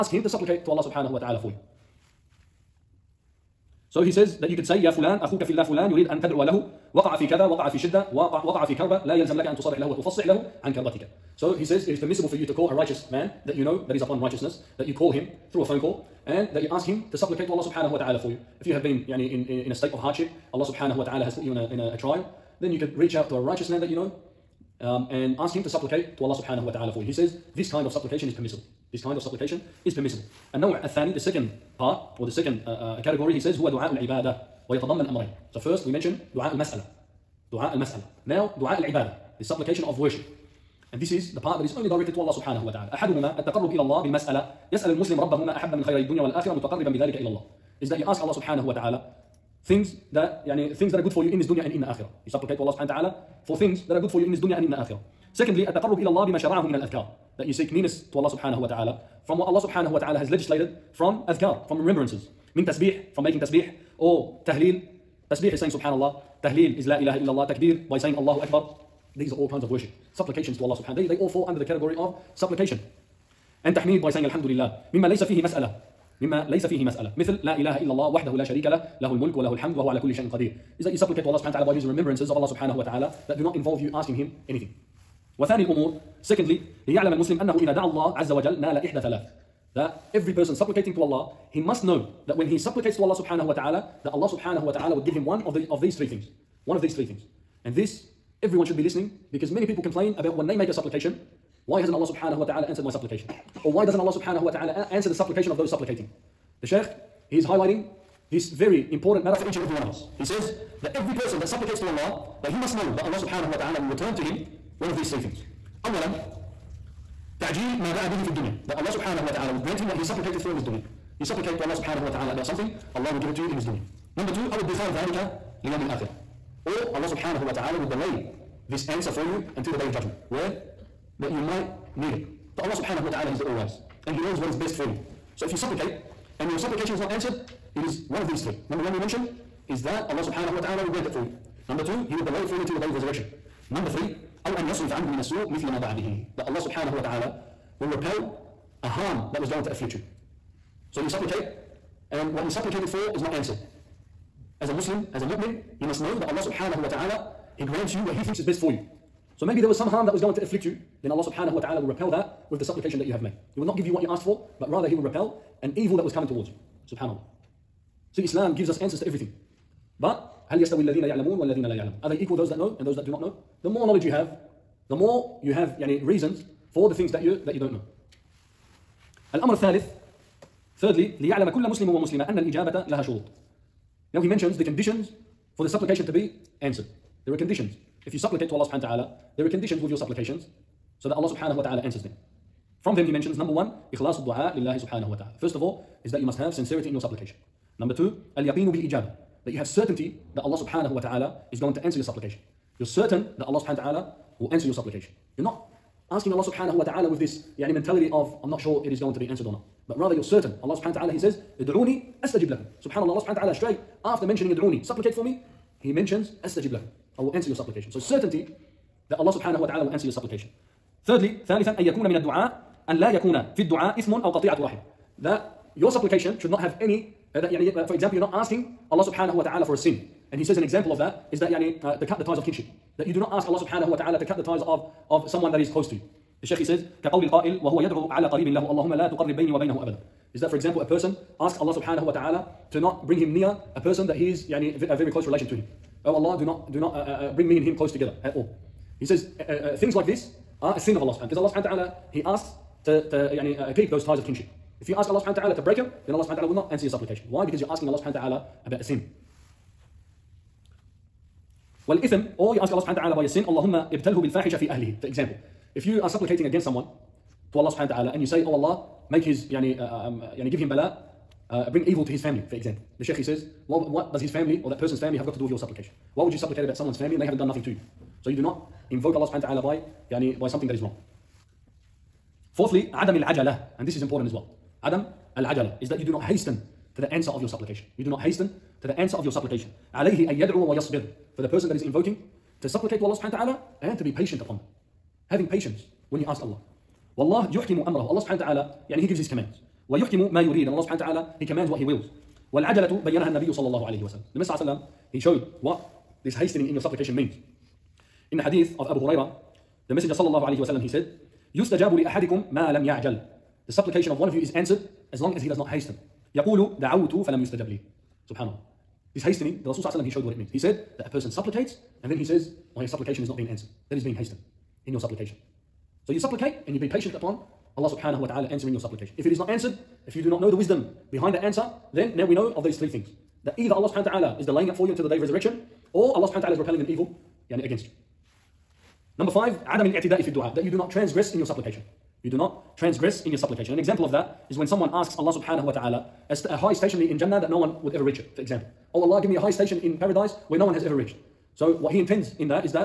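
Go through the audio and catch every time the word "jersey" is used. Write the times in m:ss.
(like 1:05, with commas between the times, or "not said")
not said.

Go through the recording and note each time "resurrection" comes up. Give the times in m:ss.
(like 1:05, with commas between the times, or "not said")
2:22, 5:35.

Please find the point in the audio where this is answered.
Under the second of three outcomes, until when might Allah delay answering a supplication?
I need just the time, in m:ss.
2:09.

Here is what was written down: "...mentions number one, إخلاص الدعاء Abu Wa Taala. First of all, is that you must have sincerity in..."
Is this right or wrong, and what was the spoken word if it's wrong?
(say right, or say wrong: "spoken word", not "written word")
wrong: "Subhanahu", not "Abu".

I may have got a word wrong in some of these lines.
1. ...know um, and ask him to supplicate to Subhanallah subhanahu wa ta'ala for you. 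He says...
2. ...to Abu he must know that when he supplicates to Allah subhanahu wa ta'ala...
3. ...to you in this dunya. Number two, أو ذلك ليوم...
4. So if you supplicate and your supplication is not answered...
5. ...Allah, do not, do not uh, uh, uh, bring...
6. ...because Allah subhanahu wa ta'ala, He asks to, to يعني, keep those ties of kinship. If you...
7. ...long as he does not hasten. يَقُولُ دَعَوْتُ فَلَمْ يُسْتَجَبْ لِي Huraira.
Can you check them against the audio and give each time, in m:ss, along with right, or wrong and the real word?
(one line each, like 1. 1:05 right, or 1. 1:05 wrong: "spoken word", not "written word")
1. 0:23 wrong: "Allah", not "Subhanallah"
2. 1:30 wrong: "Allah", not "Abu"
3. 2:03 right
4. 2:15 right
5. 4:06 right
6. 4:11 right
7. 5:15 wrong: "Subhanallah", not "Huraira".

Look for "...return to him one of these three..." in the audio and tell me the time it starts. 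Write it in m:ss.
1:53.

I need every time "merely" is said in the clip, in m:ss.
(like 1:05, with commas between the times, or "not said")
not said.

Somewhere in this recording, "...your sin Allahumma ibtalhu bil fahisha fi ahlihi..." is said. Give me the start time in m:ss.
4:23.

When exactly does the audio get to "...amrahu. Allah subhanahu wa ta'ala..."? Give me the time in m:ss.
4:57.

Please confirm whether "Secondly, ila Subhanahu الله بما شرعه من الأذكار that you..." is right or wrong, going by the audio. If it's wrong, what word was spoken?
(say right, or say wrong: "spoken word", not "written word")
wrong: "Allah", not "Subhanahu".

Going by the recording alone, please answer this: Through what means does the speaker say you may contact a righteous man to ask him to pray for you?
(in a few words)
A phone call.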